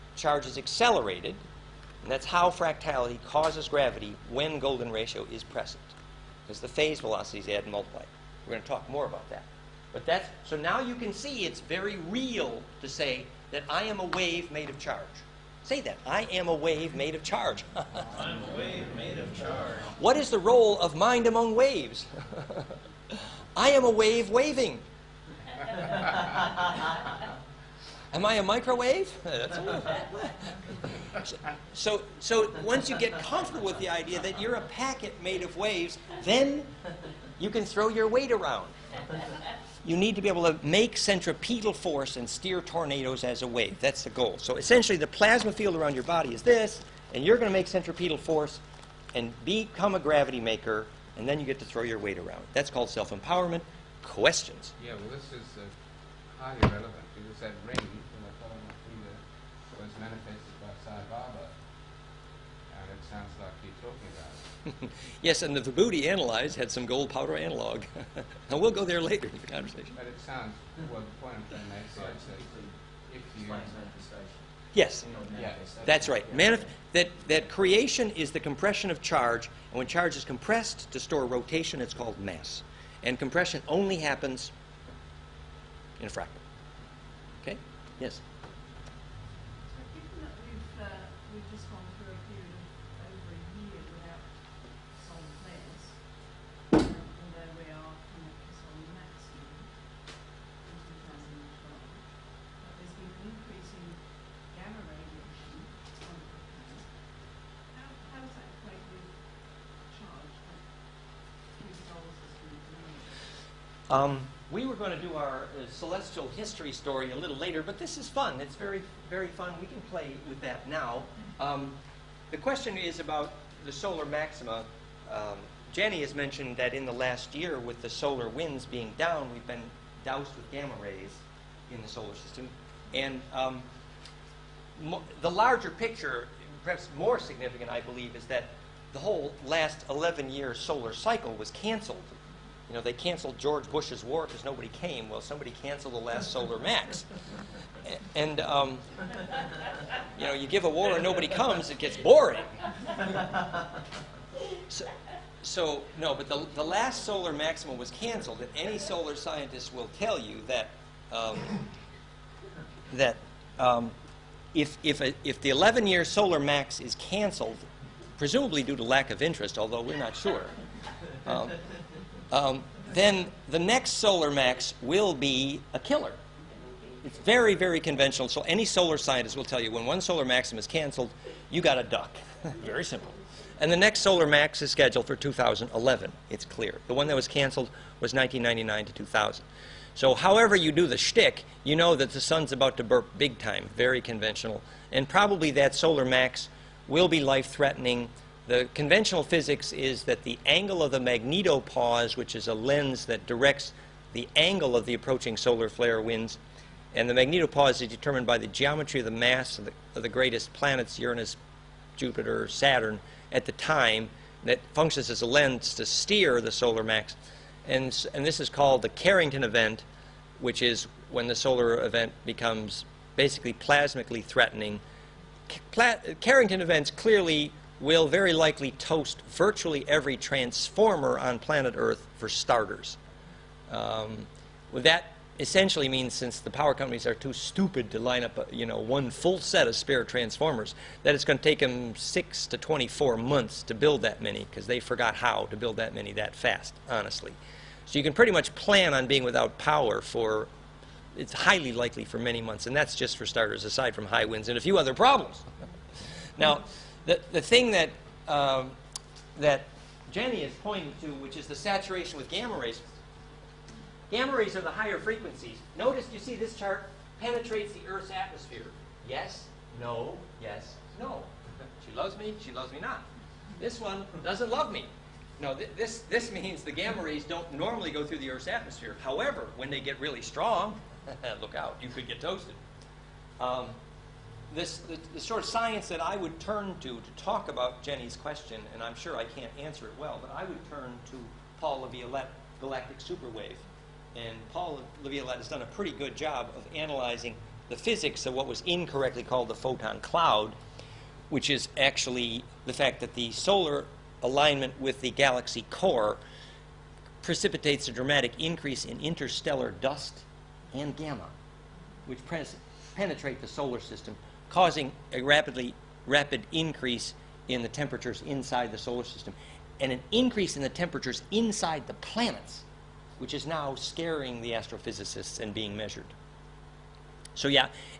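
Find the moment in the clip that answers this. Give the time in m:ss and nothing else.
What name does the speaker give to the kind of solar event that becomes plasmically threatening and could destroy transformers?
3:38.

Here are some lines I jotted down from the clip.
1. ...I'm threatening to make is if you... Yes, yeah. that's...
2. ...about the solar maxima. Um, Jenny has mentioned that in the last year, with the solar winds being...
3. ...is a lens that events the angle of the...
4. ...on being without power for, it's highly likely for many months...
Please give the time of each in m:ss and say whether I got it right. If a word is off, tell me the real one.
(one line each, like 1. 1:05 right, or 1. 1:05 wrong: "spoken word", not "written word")
1. 1:11 wrong: "trying", not "threatening"
2. 2:02 right
3. 3:22 wrong: "directs", not "events"
4. 4:08 right.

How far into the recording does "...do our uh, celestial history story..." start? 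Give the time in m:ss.
1:54.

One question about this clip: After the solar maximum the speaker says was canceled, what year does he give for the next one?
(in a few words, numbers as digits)
2011.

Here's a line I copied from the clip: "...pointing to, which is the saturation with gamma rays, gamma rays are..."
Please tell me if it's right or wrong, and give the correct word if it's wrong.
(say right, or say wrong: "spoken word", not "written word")
right.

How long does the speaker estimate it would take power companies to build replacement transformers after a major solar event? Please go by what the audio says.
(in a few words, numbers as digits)
6 to 24 months.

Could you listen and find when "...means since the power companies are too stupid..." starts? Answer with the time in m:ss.
3:55.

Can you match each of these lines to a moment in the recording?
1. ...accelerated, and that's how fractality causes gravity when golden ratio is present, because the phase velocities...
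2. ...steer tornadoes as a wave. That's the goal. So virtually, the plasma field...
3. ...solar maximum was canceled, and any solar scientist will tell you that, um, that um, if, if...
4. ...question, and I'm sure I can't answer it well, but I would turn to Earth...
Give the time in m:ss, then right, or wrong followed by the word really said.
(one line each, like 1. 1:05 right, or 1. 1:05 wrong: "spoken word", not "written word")
1. 0:00 right
2. 0:42 wrong: "essentially", not "virtually"
3. 2:37 right
4. 4:48 wrong: "Paul", not "Earth".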